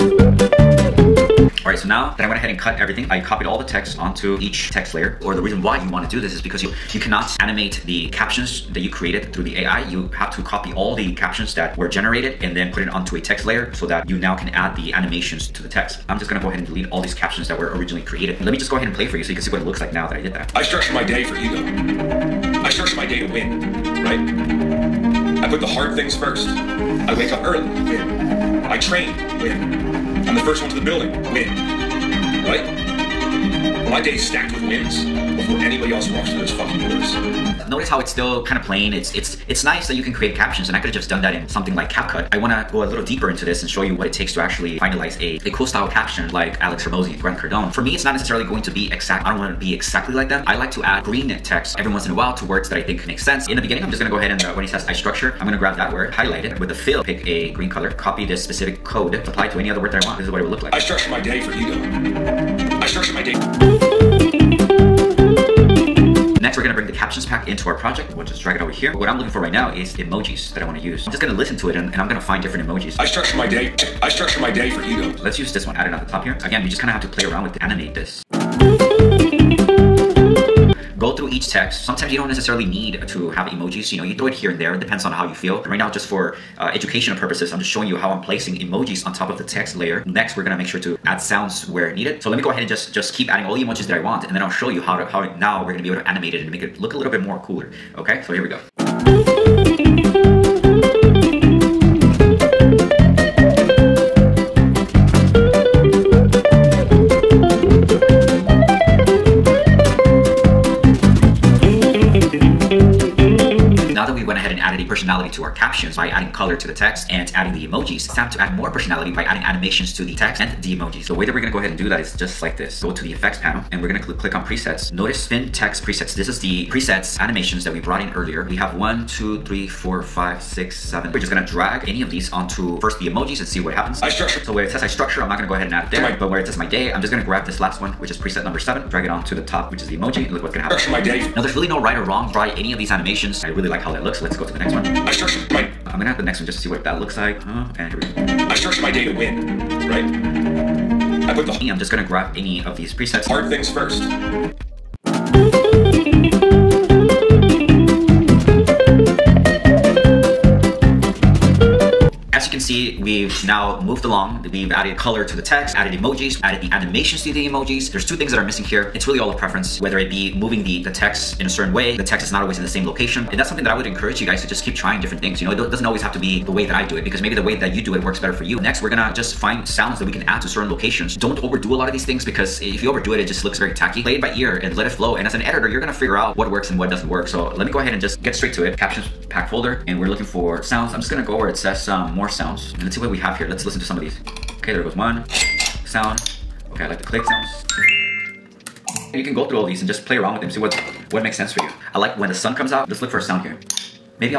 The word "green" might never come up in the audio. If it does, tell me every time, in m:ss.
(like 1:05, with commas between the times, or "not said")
0:51, 0:57.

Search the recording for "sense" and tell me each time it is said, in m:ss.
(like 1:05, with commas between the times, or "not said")
0:53, 3:21.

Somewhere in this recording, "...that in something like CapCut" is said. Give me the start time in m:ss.
0:41.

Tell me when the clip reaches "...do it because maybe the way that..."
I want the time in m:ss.
2:56.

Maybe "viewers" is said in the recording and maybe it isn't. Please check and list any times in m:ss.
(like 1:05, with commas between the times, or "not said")
not said.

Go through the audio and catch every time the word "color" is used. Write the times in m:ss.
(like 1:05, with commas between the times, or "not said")
0:57, 1:56, 2:44.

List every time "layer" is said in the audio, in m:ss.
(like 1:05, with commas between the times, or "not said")
0:04, 0:13, 1:29.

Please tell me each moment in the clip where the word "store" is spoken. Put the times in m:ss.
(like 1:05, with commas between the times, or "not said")
not said.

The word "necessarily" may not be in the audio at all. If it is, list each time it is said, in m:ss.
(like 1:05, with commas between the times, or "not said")
0:48, 1:22.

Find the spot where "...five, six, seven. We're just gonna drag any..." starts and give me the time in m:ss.
2:10.